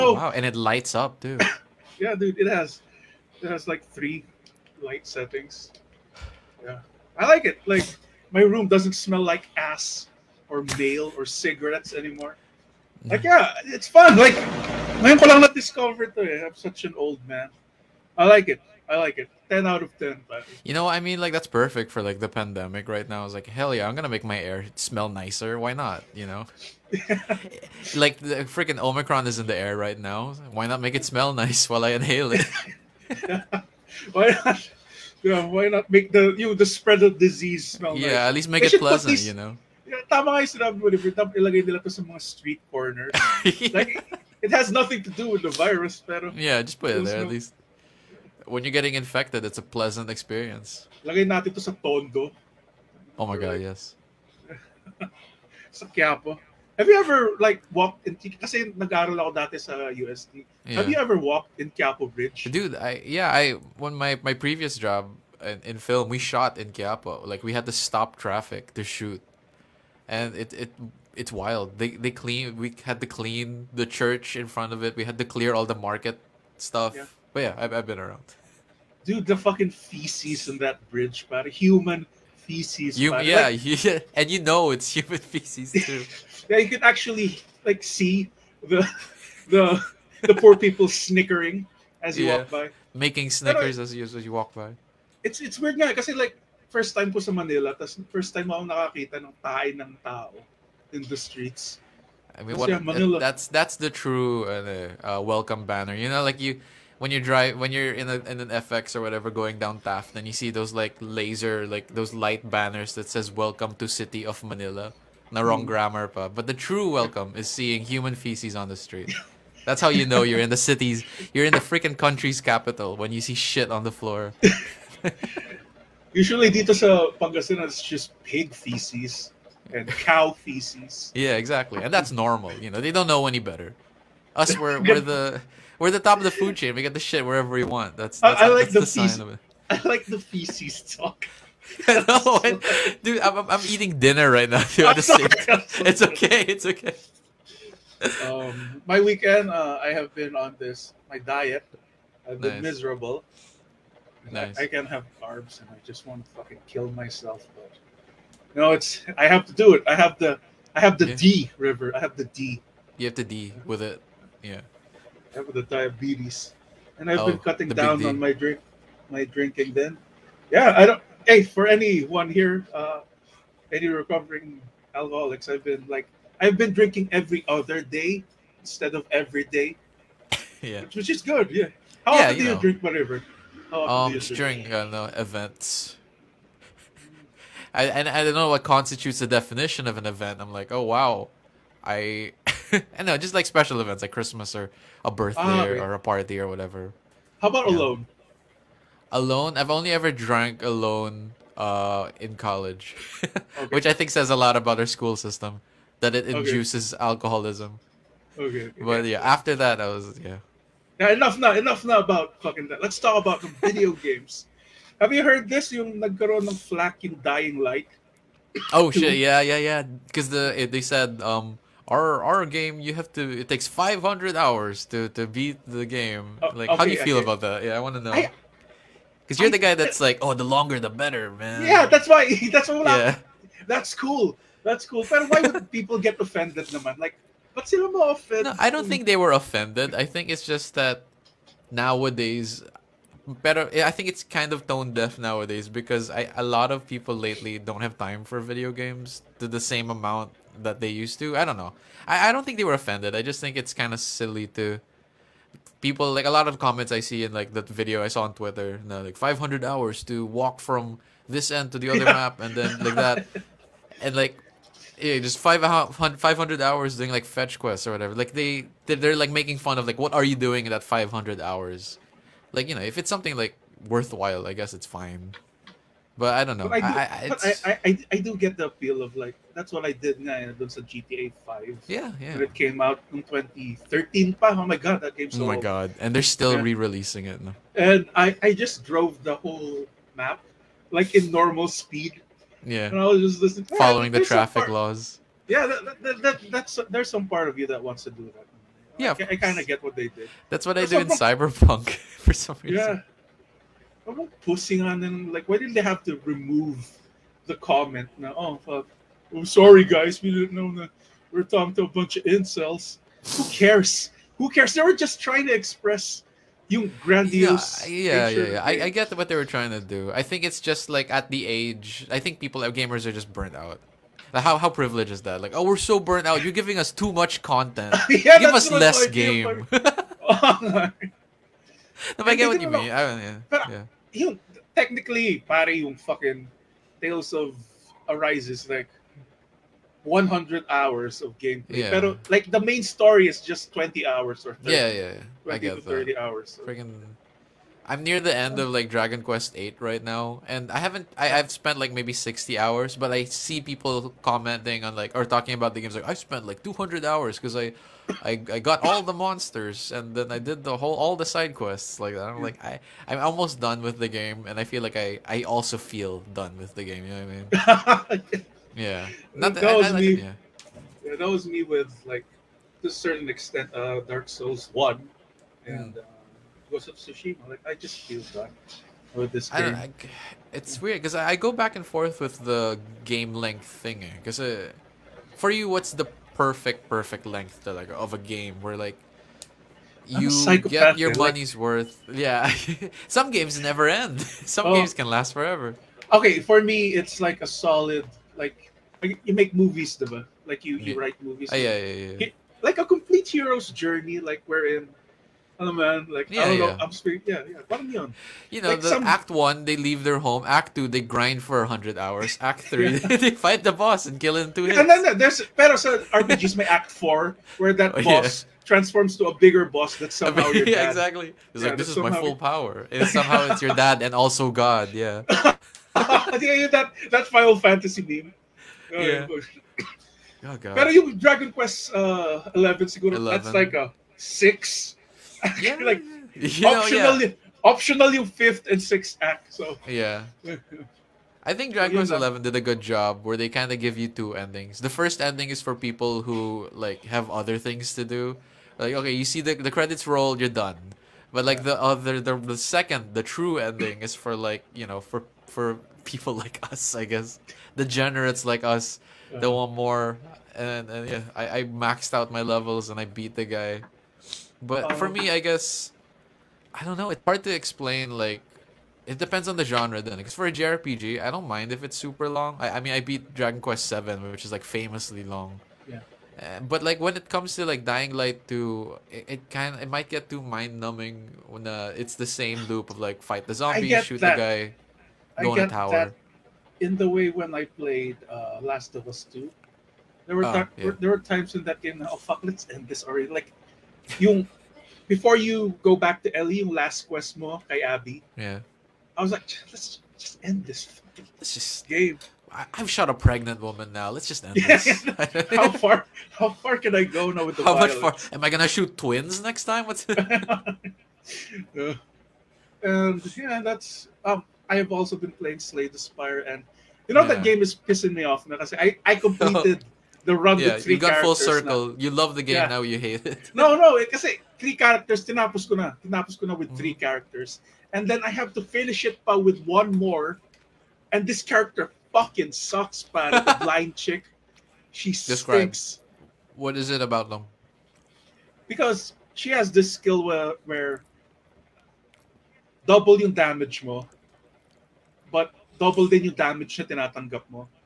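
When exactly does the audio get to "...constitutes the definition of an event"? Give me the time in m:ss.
3:08.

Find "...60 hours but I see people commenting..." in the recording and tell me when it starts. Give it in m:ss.
5:52.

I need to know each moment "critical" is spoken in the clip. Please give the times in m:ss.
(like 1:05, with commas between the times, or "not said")
not said.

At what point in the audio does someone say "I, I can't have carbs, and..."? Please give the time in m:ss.
2:34.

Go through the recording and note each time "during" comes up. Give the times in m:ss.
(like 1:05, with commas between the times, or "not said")
3:04.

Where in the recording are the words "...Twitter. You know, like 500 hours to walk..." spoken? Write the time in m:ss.
4:18.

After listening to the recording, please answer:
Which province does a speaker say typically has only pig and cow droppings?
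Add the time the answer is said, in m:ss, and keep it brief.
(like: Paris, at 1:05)
Pangasinan, at 2:07.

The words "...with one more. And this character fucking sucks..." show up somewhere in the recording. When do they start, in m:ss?
8:49.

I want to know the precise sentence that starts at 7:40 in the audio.
And, and yeah, I, I maxed out my levels and I beat the guy.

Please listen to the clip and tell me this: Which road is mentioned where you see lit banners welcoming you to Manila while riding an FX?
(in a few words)
Taft.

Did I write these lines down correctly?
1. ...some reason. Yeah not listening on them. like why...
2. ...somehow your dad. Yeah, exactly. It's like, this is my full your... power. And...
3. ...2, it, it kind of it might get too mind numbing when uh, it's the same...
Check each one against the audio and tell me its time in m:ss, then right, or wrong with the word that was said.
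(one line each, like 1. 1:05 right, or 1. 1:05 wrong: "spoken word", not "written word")
1. 5:02 wrong: "pushing", not "listening"
2. 7:00 right
3. 7:58 right.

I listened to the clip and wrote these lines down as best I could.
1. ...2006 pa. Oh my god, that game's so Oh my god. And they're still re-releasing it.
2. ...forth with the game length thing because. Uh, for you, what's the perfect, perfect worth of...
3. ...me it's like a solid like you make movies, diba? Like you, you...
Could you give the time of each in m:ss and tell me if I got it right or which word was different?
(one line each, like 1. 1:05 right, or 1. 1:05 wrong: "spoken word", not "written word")
1. 4:43 wrong: "2013", not "2006"
2. 6:21 wrong: "length", not "worth"
3. 6:36 right.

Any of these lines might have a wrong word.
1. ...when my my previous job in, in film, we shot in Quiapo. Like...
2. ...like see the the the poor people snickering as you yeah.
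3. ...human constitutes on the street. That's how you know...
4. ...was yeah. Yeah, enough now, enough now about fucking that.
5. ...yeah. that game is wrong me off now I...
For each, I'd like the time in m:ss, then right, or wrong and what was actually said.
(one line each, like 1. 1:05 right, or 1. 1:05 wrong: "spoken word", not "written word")
1. 1:03 right
2. 1:27 right
3. 1:57 wrong: "feces", not "constitutes"
4. 3:29 right
5. 8:37 wrong: "pissing", not "wrong".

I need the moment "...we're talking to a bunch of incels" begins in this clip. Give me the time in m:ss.
5:11.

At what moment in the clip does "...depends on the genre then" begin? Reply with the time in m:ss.
7:49.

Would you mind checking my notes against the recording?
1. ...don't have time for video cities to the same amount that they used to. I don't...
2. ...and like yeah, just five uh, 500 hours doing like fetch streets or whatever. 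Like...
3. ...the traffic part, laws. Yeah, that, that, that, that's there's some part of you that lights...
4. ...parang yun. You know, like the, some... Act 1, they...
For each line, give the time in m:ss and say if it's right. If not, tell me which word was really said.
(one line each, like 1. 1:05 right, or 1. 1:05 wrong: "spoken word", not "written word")
1. 4:07 wrong: "games", not "cities"
2. 4:24 wrong: "quests", not "streets"
3. 4:54 wrong: "wants", not "lights"
4. 6:47 right.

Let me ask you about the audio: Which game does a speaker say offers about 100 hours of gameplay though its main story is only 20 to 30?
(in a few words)
Tales of Arises.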